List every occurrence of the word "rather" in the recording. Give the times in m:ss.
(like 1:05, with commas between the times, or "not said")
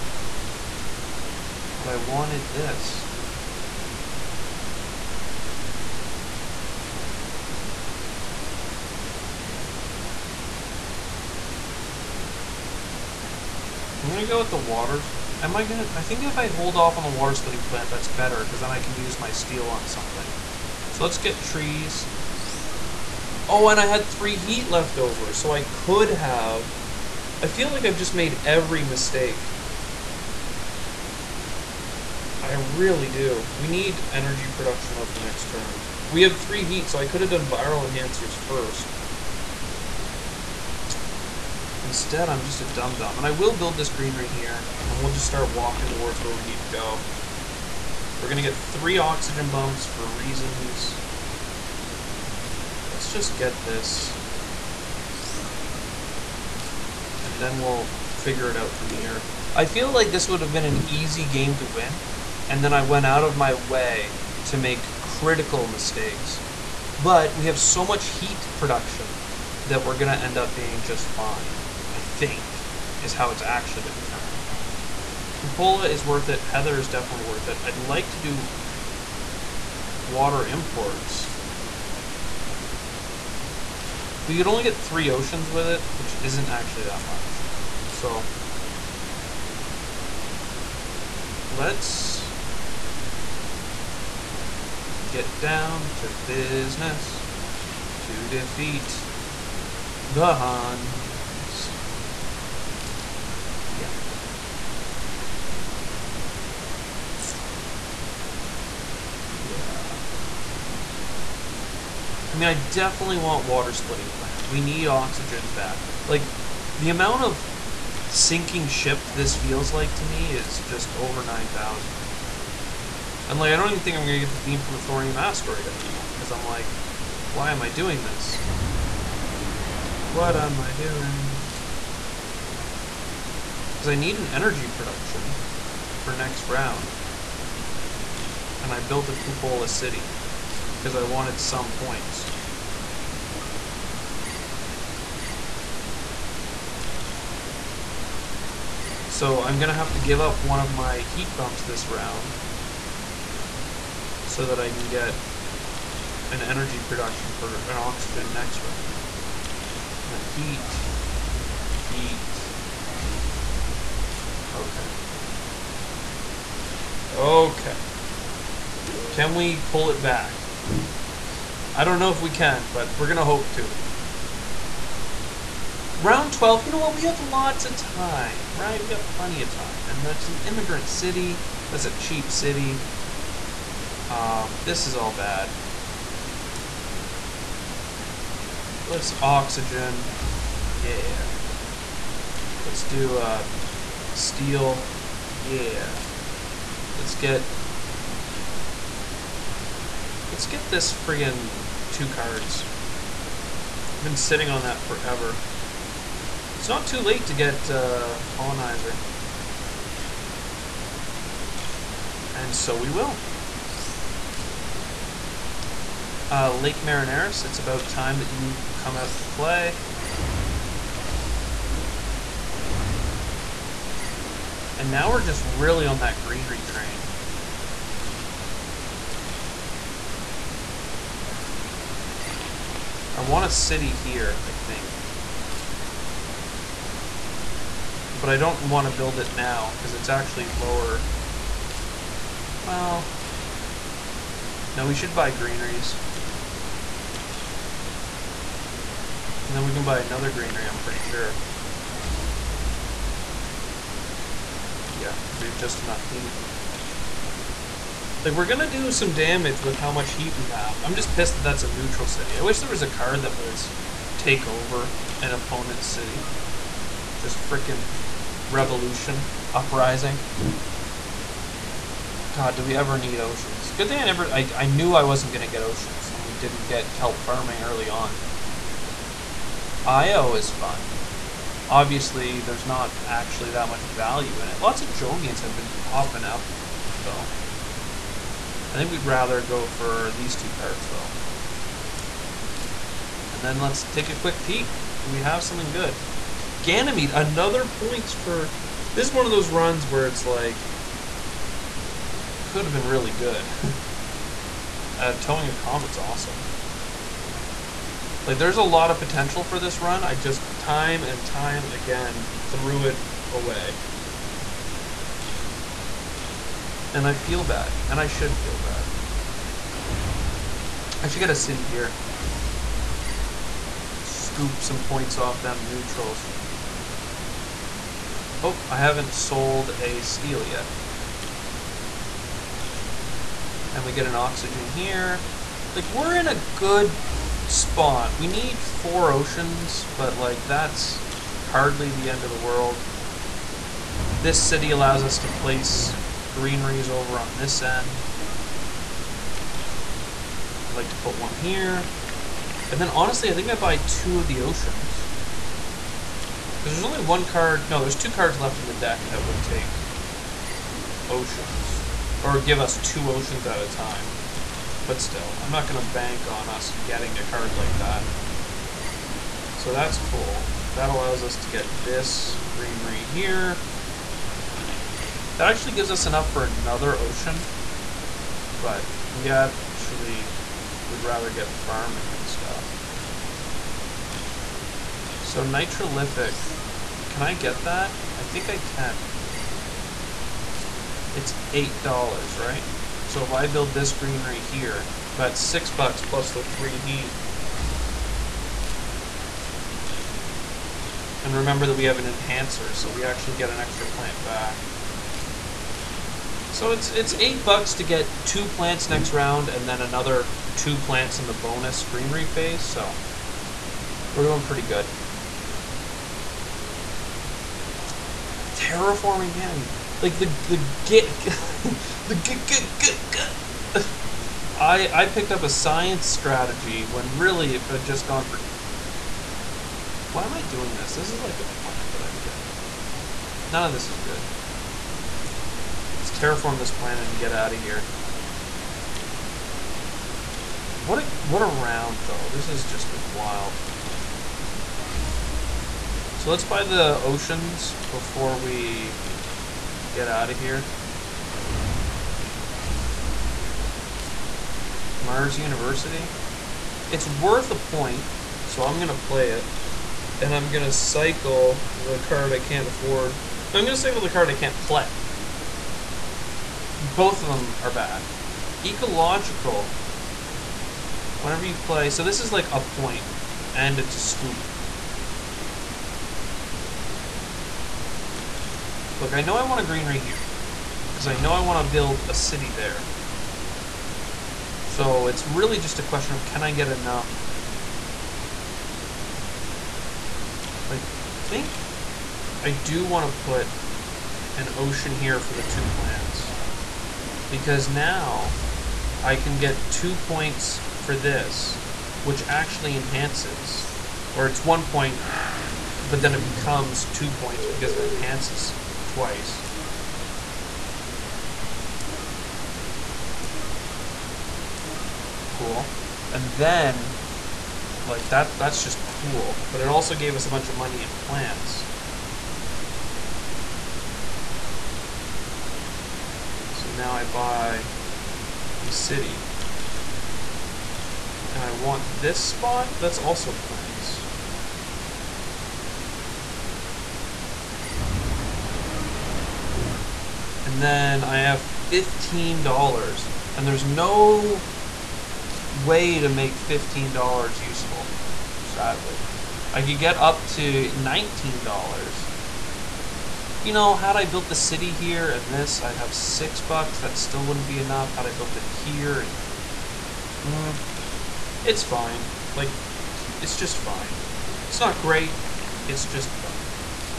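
4:49, 6:21.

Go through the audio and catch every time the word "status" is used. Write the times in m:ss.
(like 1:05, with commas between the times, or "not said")
not said.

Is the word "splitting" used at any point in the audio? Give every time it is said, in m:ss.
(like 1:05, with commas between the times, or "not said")
0:17, 1:53.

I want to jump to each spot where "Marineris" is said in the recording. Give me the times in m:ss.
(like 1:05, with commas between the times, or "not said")
3:36.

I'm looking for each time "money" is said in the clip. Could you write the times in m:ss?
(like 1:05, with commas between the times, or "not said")
8:40.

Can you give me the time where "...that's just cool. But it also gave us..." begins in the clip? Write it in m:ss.
8:38.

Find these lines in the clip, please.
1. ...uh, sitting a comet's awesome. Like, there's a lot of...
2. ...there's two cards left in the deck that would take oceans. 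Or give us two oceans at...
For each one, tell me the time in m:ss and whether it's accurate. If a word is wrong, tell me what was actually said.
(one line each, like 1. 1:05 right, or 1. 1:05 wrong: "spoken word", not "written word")
1. 5:04 wrong: "towing", not "sitting"
2. 5:57 right.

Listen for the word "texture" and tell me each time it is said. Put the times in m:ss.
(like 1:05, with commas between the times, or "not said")
not said.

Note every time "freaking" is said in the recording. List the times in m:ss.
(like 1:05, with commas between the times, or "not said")
4:27.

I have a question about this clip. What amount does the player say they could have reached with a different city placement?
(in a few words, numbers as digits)
$19.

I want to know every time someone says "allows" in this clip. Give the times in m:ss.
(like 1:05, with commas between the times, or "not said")
5:44, 6:10.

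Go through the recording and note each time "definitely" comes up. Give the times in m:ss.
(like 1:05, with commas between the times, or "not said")
1:16, 1:52.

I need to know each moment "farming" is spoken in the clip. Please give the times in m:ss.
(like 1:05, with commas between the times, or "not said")
4:37, 6:21.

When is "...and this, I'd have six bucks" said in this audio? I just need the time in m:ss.
9:15.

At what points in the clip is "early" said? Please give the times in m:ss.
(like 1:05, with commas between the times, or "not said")
4:37.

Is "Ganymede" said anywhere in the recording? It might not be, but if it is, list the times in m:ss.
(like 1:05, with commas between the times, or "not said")
4:56, 6:59.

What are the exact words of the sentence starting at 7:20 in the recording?
What a, what a round, though.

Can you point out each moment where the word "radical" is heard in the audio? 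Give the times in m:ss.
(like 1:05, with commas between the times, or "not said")
not said.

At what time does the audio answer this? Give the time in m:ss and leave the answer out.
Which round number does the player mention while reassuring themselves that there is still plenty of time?
2:55.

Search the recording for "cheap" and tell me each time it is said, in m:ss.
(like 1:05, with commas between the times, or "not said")
3:01.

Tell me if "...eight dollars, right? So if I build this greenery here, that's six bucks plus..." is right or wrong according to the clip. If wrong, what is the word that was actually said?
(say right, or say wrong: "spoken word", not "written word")
right.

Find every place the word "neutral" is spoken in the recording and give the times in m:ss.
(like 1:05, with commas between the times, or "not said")
4:21, 5:25.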